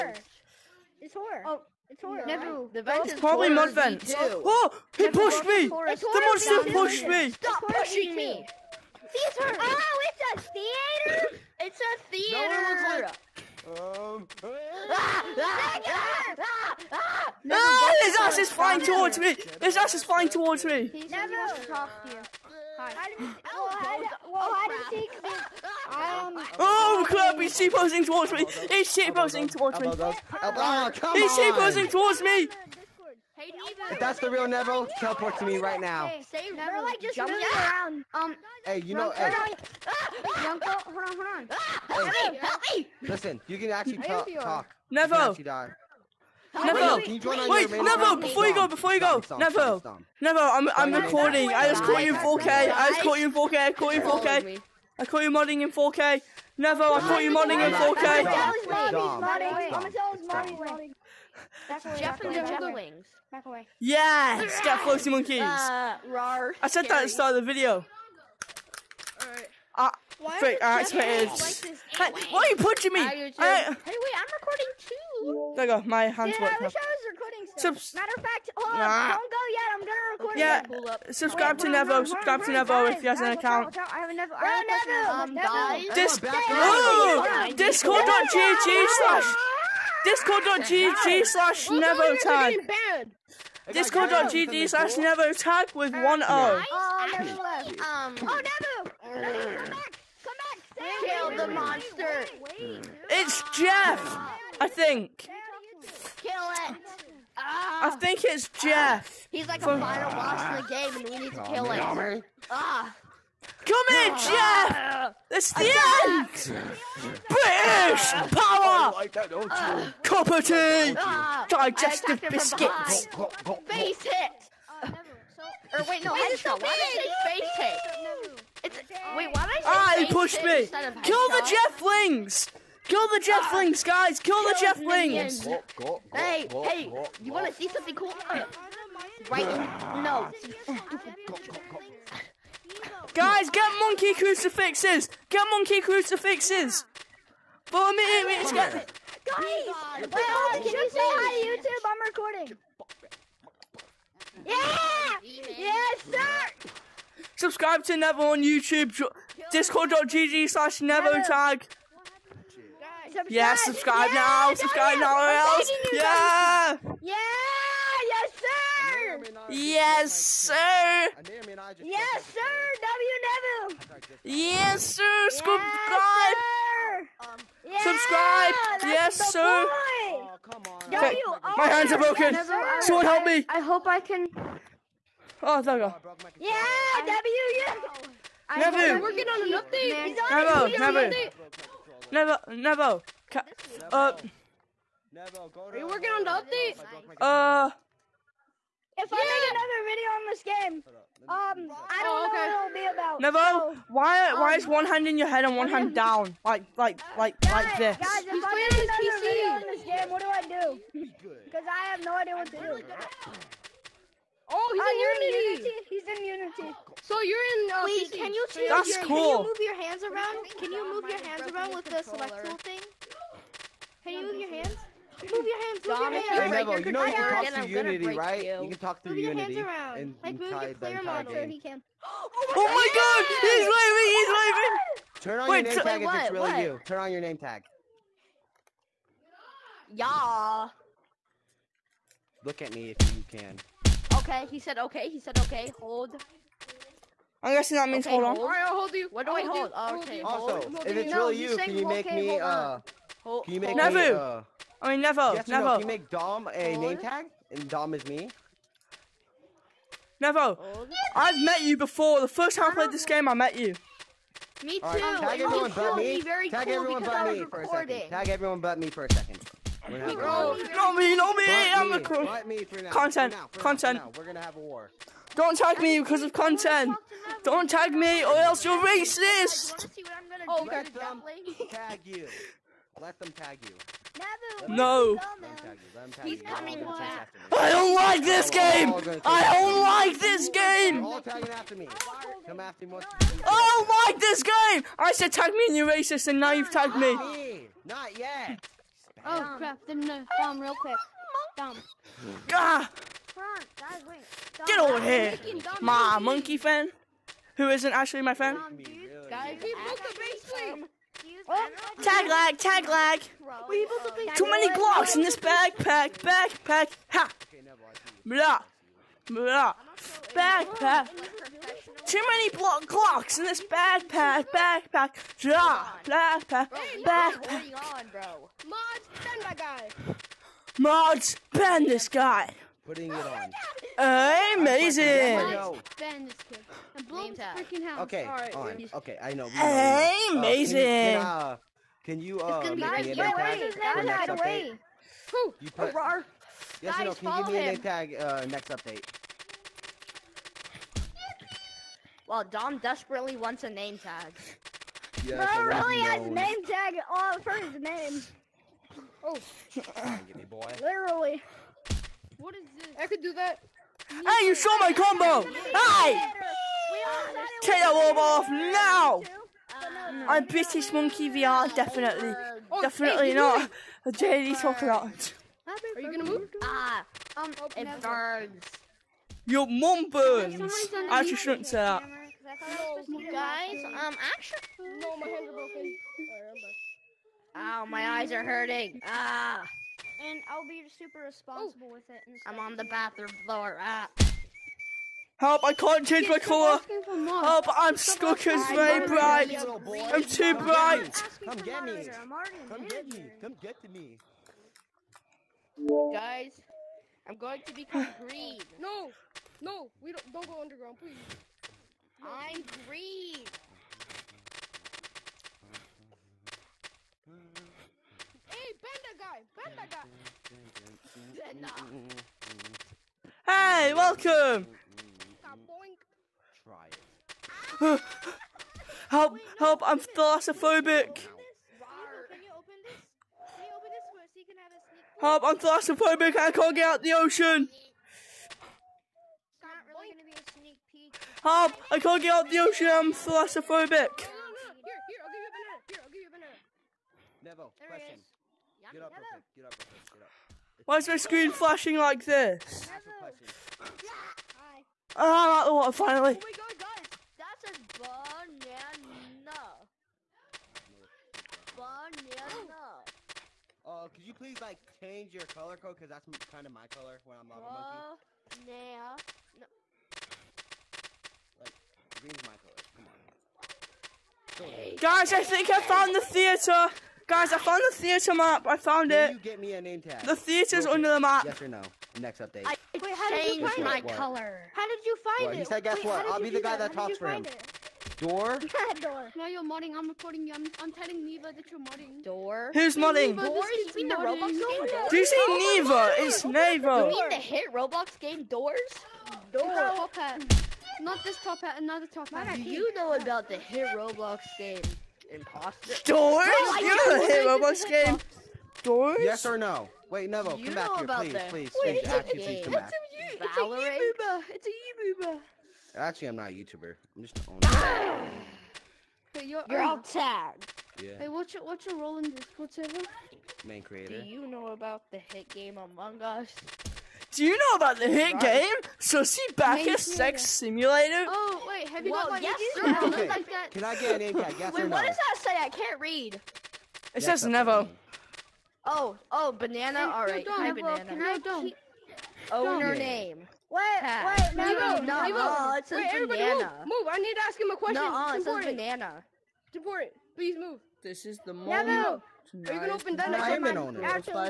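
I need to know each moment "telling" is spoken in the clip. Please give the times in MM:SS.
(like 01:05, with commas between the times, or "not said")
08:10.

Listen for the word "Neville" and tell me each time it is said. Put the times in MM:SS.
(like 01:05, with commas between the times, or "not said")
02:53.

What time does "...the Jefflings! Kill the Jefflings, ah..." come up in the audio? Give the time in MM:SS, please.
02:11.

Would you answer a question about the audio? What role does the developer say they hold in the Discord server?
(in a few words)
Main creator.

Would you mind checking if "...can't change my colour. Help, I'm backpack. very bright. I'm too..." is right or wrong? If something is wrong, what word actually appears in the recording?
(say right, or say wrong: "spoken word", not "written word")
wrong: "stuck", not "backpack".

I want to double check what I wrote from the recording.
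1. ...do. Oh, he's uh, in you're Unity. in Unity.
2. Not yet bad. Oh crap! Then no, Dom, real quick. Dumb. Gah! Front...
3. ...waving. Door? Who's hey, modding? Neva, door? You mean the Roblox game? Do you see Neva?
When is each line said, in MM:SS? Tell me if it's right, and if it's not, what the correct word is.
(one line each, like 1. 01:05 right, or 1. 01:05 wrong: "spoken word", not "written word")
1. 03:32 right
2. 04:57 right
3. 08:11 wrong: "modding", not "waving".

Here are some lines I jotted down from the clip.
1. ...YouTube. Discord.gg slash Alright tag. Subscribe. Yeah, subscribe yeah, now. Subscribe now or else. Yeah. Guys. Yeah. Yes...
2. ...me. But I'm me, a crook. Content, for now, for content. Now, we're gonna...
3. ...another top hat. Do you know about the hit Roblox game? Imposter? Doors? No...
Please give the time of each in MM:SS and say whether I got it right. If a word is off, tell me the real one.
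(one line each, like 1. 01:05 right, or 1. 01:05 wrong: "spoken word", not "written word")
1. 02:38 wrong: "Never", not "Alright"
2. 04:31 right
3. 08:21 right.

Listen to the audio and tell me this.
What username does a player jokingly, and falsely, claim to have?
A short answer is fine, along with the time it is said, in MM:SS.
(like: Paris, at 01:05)
British Monkey VR, at 06:10.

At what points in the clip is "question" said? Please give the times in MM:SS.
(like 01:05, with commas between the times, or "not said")
07:27, 09:07.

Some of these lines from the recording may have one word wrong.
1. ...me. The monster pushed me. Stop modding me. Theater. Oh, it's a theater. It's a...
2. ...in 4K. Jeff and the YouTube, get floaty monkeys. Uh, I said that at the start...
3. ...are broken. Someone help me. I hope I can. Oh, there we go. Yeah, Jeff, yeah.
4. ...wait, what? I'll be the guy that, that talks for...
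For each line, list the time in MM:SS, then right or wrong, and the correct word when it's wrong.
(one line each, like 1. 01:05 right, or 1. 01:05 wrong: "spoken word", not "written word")
1. 00:05 wrong: "pushing", not "modding"
2. 00:57 wrong: "Yes", not "YouTube"
3. 03:01 wrong: "Debbie", not "Jeff"
4. 08:05 right.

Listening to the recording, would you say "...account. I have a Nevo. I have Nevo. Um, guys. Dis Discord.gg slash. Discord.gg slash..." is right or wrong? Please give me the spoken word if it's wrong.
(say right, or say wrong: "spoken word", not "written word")
right.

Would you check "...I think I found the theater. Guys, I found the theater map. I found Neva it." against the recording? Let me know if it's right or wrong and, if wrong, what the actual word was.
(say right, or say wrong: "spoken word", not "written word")
wrong: "Can", not "Neva".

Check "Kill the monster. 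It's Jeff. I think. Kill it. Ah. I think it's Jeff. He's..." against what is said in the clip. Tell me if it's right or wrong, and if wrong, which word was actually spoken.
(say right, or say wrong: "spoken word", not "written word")
right.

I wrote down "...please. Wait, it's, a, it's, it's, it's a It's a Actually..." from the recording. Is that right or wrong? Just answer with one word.
right.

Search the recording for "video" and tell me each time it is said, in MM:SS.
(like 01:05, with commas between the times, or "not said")
01:07, 03:20, 03:29.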